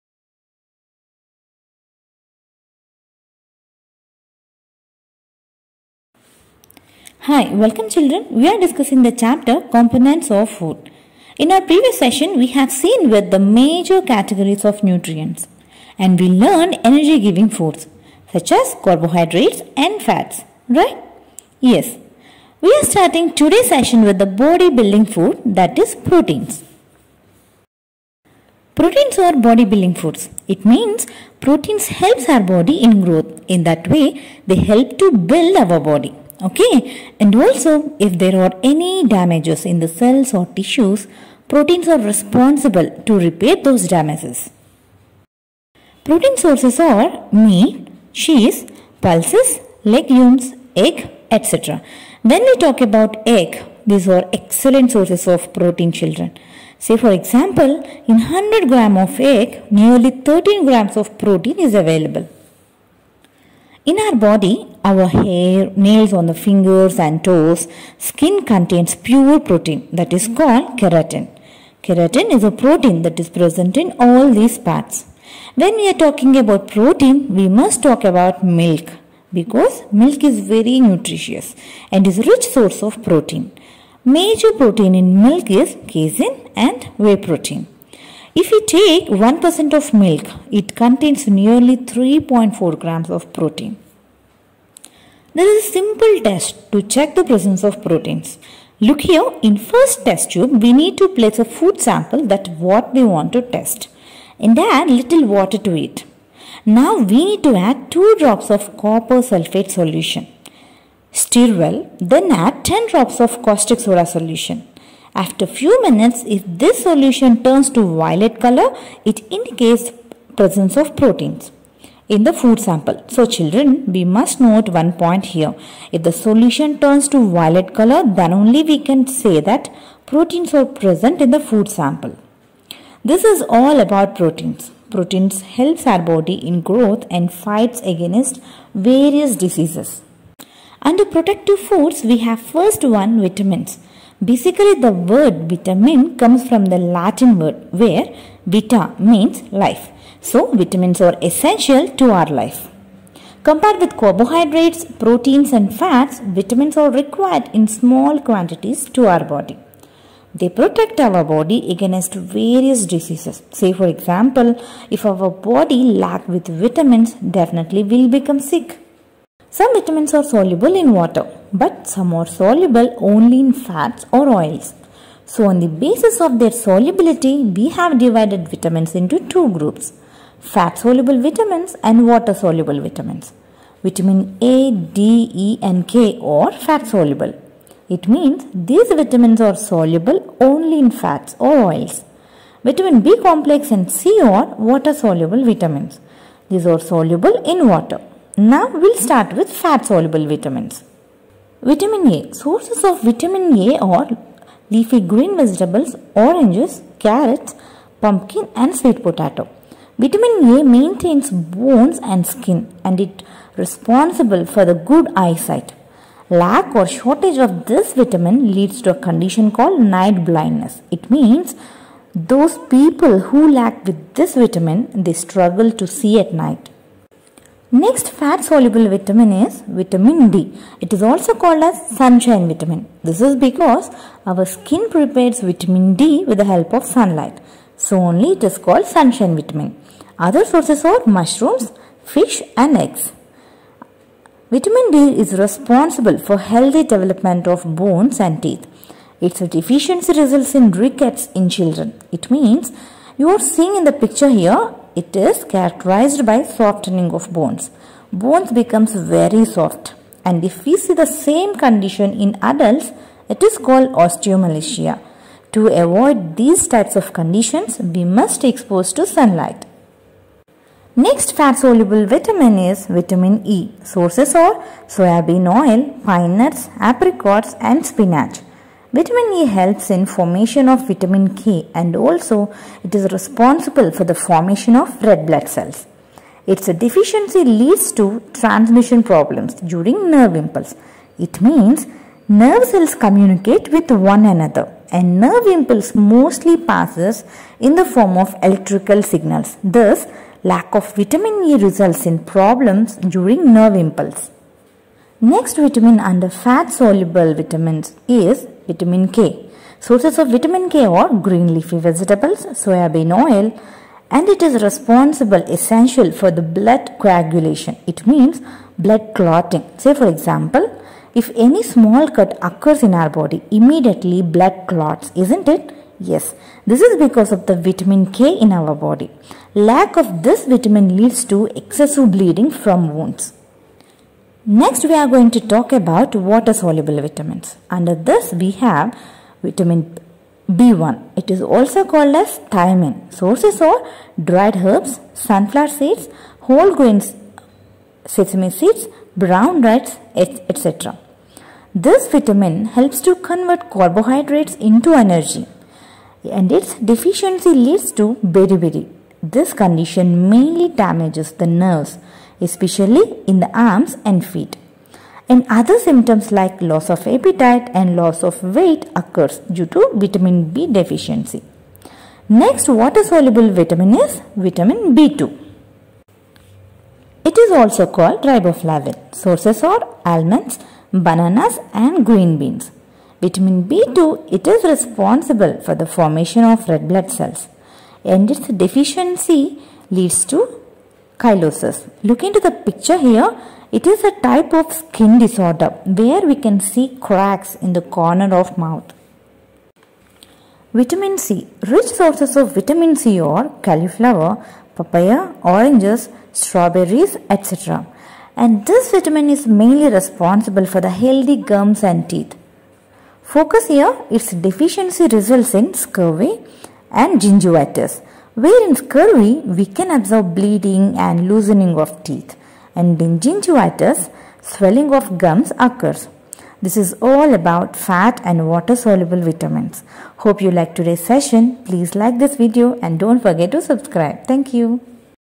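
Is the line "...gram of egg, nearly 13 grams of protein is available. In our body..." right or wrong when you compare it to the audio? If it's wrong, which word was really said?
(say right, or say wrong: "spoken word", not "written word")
right.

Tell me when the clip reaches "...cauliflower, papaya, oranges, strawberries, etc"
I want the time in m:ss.
6:43.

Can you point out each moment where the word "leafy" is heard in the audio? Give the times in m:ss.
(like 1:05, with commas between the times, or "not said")
3:24, 5:11.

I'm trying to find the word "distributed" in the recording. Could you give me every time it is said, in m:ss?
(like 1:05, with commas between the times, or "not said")
not said.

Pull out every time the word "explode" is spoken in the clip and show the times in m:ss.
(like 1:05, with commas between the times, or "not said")
not said.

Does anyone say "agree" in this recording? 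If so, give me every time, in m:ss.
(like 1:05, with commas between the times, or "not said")
not said.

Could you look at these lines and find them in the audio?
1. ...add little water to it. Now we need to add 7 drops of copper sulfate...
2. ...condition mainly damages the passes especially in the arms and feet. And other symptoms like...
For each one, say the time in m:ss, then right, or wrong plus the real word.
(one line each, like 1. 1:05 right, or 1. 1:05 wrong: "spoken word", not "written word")
1. 1:44 wrong: "2", not "7"
2. 5:59 wrong: "nerves", not "passes".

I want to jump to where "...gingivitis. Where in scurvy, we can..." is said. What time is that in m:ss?
6:57.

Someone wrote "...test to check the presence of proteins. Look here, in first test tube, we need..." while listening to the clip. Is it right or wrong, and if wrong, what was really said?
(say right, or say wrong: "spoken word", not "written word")
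right.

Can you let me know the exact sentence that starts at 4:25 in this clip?
To avoid these types of conditions, we must expose to sunlight.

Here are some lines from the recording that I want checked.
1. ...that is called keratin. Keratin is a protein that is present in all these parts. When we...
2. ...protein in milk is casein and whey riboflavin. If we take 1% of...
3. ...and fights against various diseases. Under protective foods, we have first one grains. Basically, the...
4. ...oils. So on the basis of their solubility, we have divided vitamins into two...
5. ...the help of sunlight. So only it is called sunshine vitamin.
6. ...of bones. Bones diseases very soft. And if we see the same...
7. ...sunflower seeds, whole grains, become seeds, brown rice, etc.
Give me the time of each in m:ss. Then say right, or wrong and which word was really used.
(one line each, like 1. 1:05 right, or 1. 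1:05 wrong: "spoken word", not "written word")
1. 1:09 right
2. 1:24 wrong: "protein", not "riboflavin"
3. 2:17 wrong: "vitamins", not "grains"
4. 2:54 right
5. 3:56 right
6. 4:17 wrong: "becomes", not "diseases"
7. 5:45 wrong: "sesame", not "become".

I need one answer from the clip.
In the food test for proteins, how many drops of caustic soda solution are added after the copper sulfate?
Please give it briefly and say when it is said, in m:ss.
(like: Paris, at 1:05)
10, at 1:52.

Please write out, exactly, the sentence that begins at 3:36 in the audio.
Lack or shortage of this vitamin leads to a condition called night blindness.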